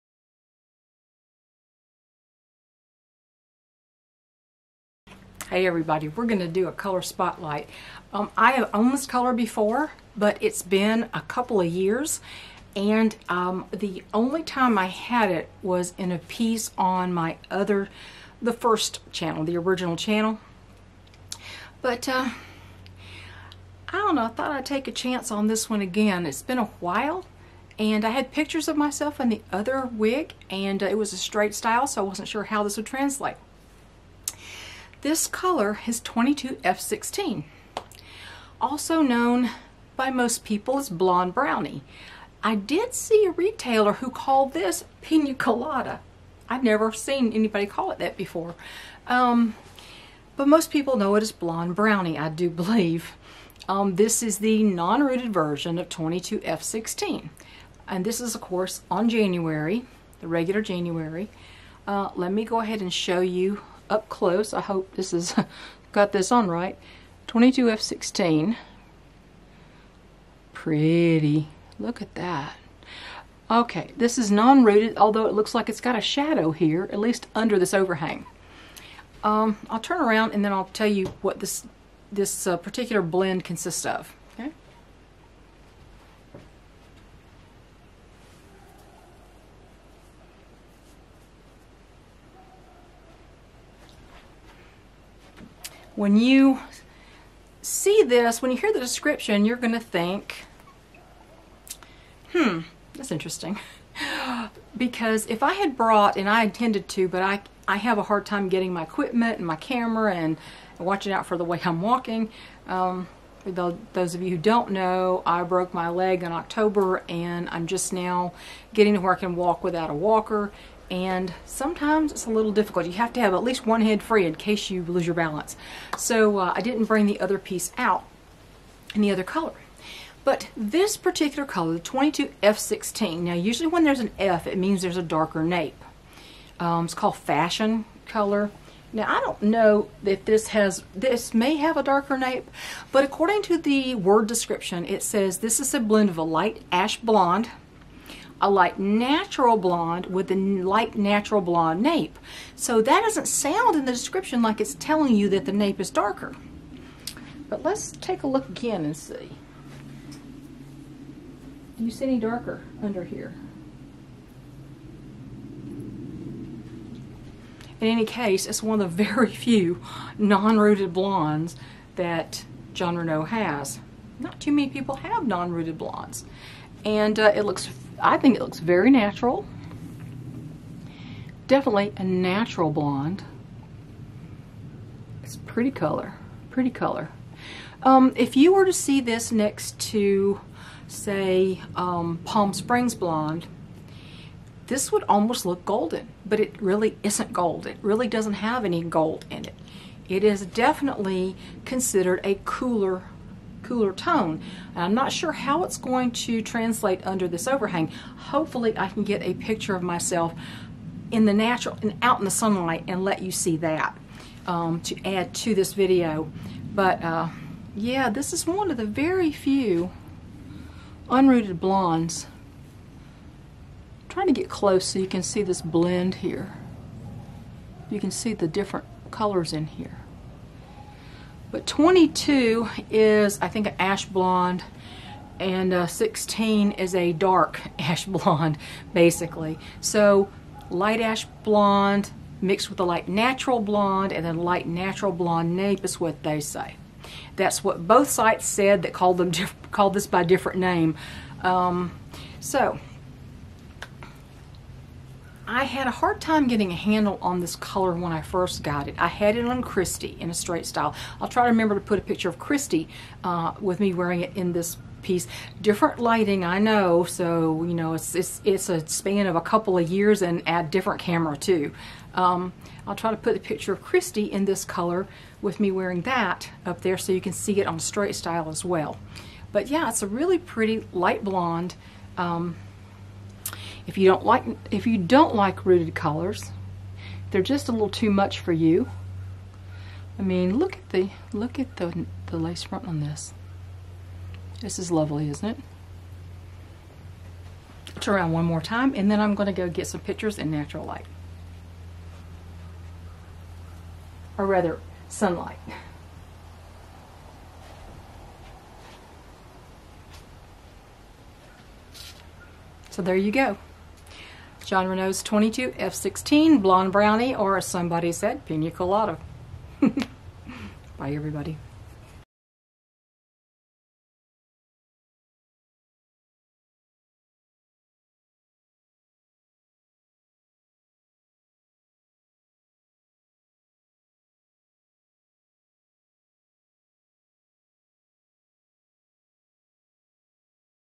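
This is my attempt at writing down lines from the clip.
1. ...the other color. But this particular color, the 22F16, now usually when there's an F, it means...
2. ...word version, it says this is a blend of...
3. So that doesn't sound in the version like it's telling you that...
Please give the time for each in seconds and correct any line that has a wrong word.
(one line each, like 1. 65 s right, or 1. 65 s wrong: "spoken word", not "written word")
1. 129 s right
2. 143 s wrong: "description", not "version"
3. 152 s wrong: "description", not "version".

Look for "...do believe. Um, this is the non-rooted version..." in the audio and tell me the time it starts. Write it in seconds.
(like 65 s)
52 s.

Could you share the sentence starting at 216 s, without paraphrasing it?
But uh, yeah, this is one of the very few unrooted blondes.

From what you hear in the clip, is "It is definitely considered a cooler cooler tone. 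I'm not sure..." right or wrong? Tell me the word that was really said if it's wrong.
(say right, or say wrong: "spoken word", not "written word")
right.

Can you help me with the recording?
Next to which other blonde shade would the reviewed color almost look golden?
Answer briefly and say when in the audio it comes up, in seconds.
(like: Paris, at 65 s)
Palm Springs Blonde, at 192 s.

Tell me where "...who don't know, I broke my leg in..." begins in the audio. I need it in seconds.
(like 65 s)
114 s.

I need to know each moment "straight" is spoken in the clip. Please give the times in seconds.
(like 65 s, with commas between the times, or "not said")
31 s, 260 s, 277 s.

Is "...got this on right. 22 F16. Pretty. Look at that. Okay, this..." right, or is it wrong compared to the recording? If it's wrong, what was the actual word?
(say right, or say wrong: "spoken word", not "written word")
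right.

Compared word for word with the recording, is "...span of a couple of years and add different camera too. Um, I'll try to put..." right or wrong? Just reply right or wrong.
right.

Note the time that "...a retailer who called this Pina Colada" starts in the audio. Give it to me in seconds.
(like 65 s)
43 s.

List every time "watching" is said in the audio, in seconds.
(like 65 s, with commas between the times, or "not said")
110 s.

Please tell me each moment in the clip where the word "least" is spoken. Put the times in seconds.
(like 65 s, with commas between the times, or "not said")
76 s, 123 s.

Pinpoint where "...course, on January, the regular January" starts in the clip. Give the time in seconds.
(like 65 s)
58 s.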